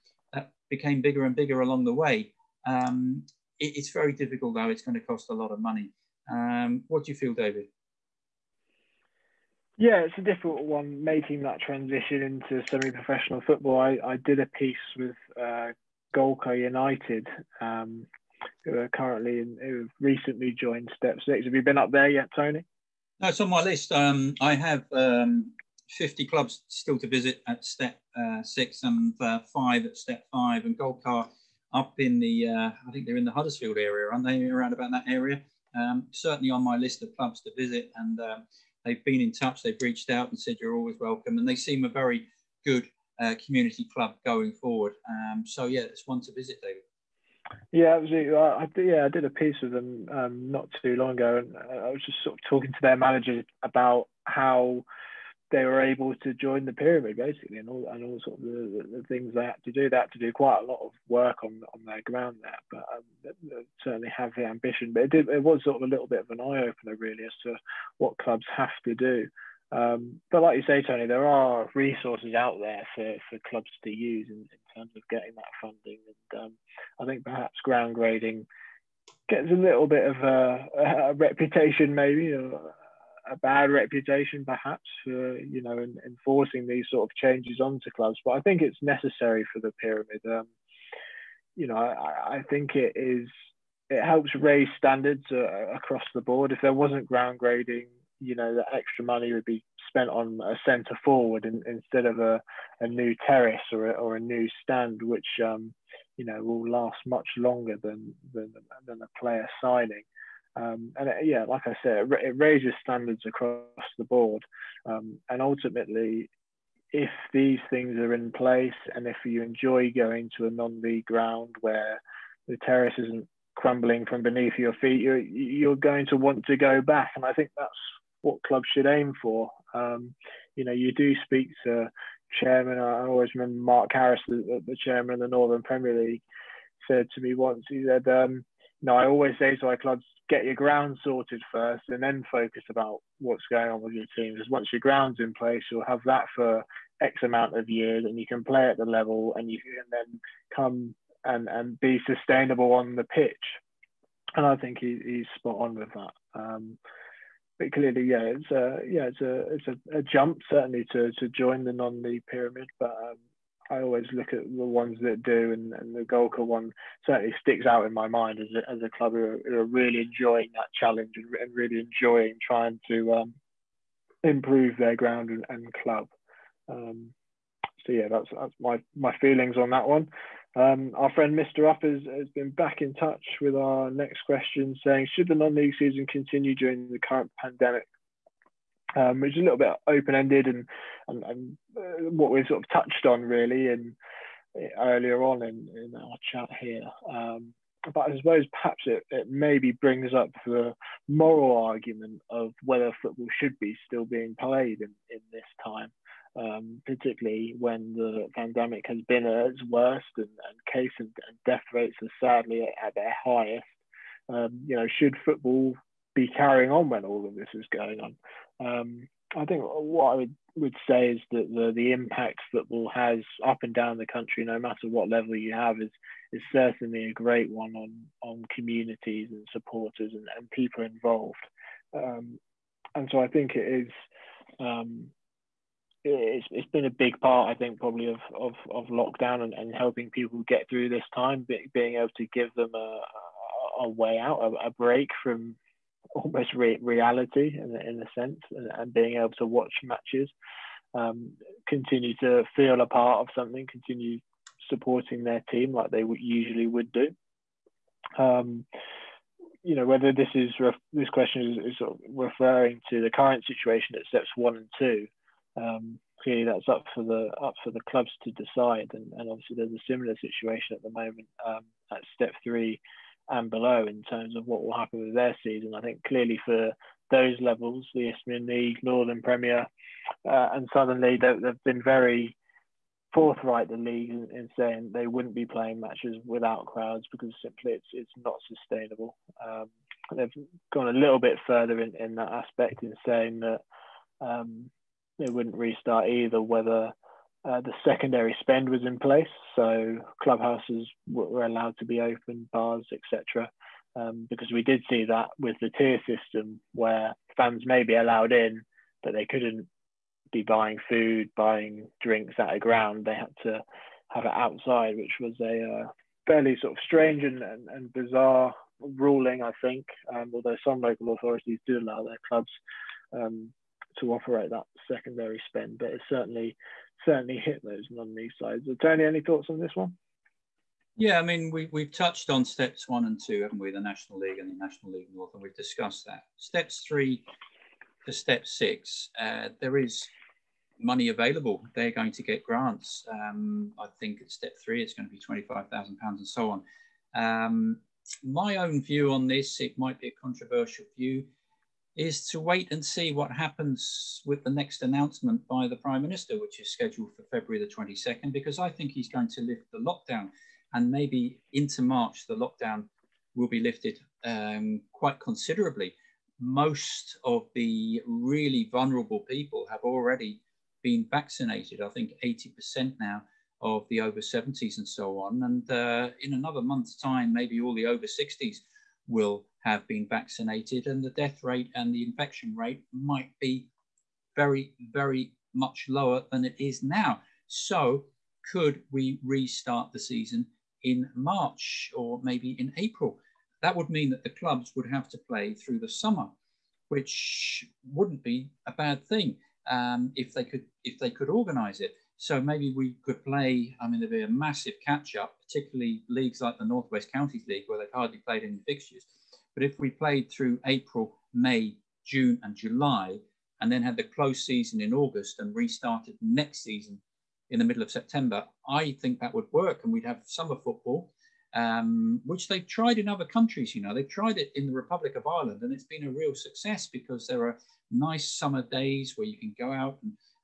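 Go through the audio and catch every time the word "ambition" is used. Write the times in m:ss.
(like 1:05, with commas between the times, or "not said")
1:04.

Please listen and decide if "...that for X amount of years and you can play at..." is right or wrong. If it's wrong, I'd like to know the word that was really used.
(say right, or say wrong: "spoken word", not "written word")
right.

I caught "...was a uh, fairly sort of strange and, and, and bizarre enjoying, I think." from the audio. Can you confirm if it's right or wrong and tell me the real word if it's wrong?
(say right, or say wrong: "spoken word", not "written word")
wrong: "ruling", not "enjoying".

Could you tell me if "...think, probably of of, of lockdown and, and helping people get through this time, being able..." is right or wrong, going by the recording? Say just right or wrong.
right.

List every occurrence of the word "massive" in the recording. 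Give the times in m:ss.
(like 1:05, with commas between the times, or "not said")
6:44.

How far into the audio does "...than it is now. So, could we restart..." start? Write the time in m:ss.
6:26.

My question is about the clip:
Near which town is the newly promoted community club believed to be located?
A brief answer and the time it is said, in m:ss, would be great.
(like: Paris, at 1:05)
Huddersfield, at 0:33.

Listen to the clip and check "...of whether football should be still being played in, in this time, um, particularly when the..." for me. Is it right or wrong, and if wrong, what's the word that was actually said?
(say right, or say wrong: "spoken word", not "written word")
right.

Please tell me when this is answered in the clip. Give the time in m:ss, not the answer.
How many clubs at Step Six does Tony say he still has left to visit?
0:25.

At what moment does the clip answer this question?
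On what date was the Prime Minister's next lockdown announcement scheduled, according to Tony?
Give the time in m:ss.
5:57.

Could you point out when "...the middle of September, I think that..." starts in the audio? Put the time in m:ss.
6:57.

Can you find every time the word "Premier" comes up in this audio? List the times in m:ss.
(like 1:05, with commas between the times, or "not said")
2:15, 4:39.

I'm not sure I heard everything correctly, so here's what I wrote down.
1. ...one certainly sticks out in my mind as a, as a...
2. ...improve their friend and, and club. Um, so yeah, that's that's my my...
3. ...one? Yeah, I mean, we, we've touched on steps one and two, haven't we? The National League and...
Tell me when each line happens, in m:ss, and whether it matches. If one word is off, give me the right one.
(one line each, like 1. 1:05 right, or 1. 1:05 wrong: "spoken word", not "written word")
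1. 2:46 right
2. 2:54 wrong: "ground", not "friend"
3. 5:29 right.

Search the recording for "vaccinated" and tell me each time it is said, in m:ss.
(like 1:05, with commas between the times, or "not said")
6:11, 6:20.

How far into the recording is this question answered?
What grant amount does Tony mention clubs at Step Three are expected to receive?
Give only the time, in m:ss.
5:45.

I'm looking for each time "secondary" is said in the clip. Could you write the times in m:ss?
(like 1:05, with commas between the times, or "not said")
4:57, 5:24.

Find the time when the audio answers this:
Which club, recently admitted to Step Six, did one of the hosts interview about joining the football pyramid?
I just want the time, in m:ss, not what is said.
0:16.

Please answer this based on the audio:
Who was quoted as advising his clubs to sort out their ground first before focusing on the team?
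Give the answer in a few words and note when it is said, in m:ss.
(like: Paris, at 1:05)
Mark Harris, at 2:13.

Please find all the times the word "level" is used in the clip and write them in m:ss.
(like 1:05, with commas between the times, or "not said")
2:28, 3:45, 4:37.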